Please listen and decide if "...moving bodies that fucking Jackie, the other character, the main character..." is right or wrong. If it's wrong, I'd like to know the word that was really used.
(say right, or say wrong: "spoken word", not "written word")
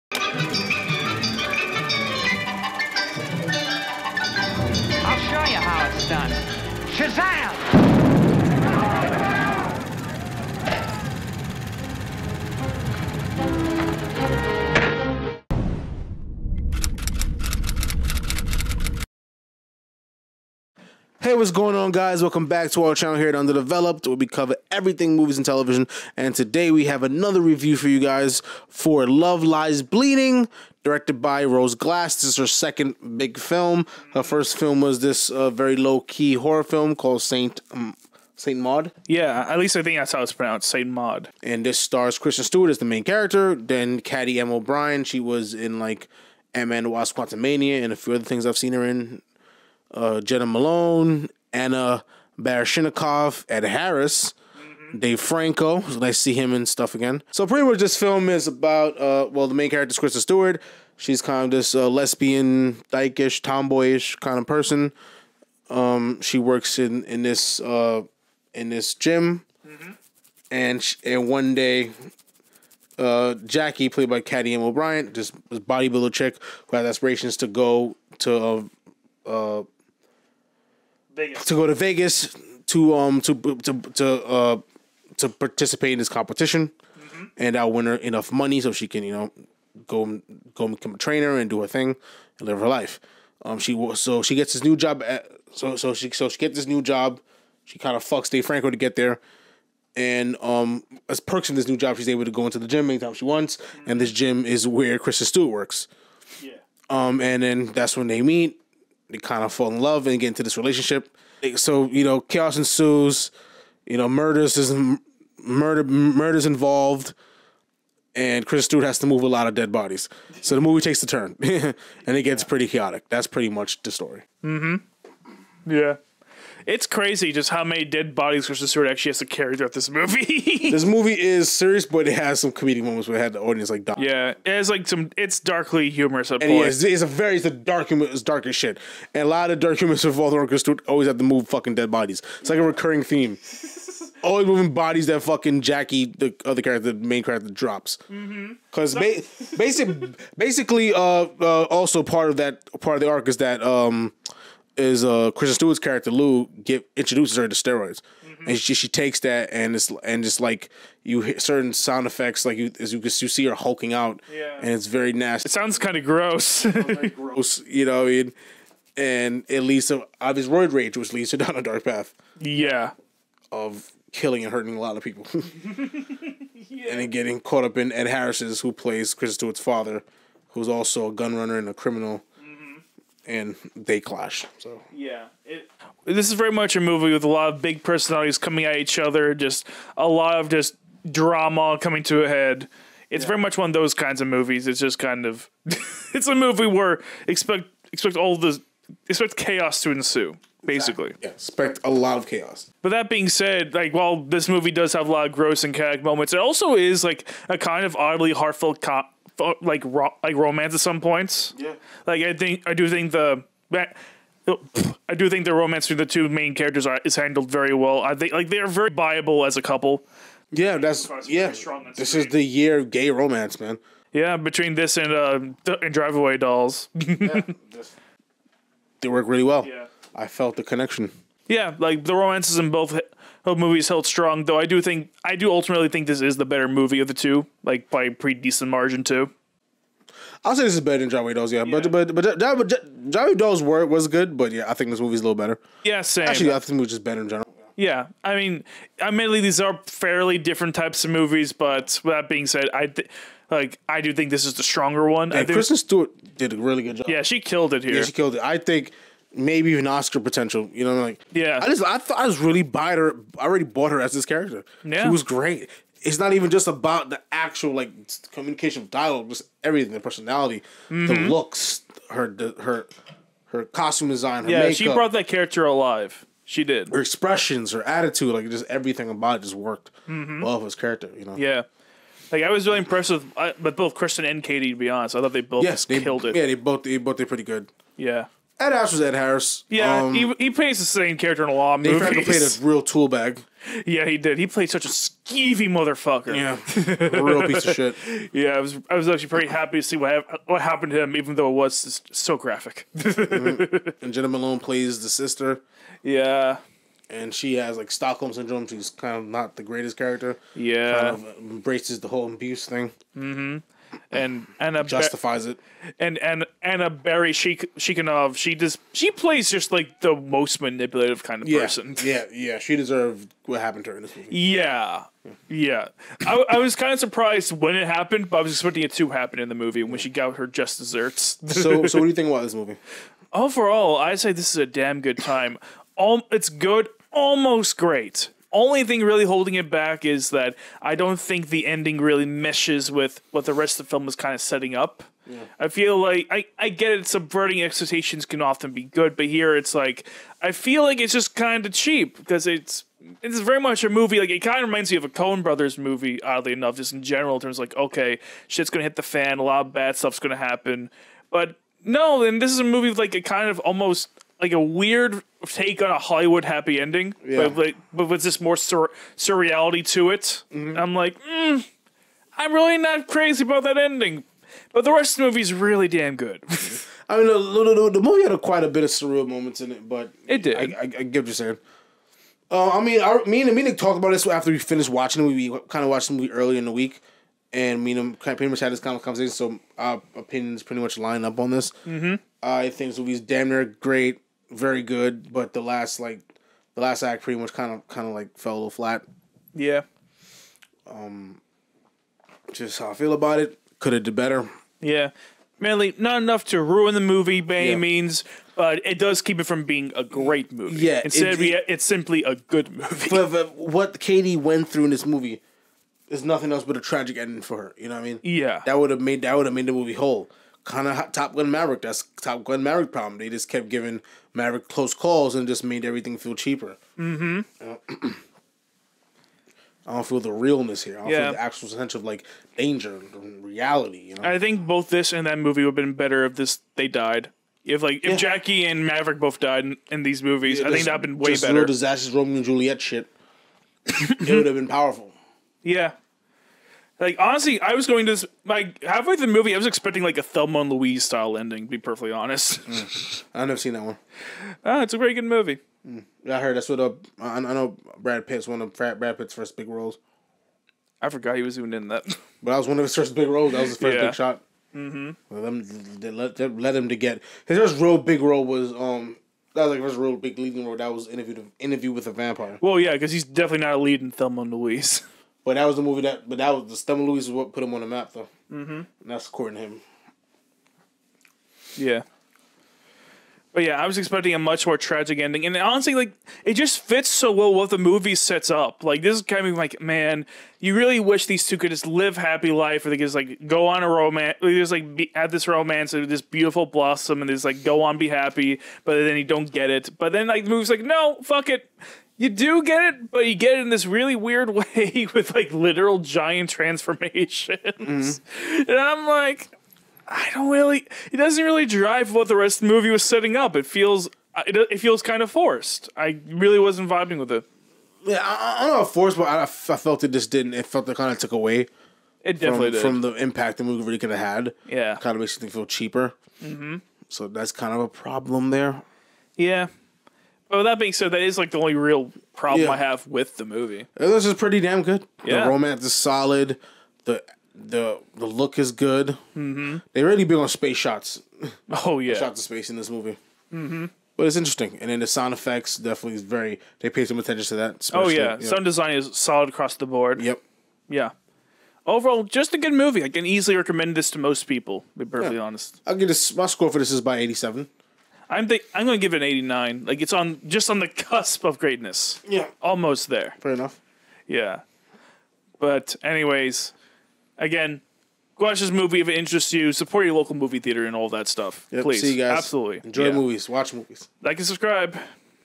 right.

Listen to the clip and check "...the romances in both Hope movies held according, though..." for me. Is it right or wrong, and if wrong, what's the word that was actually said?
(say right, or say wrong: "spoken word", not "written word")
wrong: "strong", not "according".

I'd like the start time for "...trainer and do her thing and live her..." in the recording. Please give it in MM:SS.
01:30.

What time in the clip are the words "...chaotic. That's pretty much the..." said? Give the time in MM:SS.
02:02.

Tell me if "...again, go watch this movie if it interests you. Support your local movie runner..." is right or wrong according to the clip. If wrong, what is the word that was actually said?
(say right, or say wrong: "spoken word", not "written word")
wrong: "theater", not "runner".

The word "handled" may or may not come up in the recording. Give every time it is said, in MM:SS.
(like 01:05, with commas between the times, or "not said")
03:37.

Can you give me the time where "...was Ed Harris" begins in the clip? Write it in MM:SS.
04:48.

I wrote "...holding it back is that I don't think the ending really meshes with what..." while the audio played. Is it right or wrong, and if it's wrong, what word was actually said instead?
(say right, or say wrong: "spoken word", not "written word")
right.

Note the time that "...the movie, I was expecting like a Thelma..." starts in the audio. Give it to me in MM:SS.
07:29.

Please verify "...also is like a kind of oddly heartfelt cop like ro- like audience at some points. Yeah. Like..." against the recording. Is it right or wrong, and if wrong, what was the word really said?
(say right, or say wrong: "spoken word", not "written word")
wrong: "romance", not "audience".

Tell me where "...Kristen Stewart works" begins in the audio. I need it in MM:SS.
01:44.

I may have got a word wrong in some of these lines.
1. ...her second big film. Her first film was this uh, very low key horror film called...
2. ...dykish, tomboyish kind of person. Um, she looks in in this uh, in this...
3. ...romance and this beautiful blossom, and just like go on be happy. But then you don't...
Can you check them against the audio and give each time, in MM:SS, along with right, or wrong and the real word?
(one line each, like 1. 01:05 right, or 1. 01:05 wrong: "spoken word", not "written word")
1. 00:32 right
2. 01:02 wrong: "works", not "looks"
3. 08:15 right.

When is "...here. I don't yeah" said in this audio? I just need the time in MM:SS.
07:10.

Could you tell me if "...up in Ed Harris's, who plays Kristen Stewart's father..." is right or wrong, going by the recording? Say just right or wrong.
right.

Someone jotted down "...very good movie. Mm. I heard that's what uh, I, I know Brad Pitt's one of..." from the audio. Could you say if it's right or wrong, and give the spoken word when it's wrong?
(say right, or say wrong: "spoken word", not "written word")
right.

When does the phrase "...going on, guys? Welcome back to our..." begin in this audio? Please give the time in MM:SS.
00:21.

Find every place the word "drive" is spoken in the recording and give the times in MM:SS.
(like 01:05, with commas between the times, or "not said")
03:45, 08:31.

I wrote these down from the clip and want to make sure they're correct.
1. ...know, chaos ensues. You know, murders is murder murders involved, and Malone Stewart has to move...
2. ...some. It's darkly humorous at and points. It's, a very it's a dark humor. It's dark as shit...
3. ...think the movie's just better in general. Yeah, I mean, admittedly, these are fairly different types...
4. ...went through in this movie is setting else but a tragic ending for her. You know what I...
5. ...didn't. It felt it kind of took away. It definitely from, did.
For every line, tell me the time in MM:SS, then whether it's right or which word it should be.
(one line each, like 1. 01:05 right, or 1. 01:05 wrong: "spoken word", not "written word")
1. 01:52 wrong: "Chris", not "Malone"
2. 02:14 right
3. 04:06 right
4. 06:54 wrong: "nothing", not "setting"
5. 08:40 right.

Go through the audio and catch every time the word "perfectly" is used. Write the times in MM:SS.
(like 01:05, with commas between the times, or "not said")
07:31, 09:15.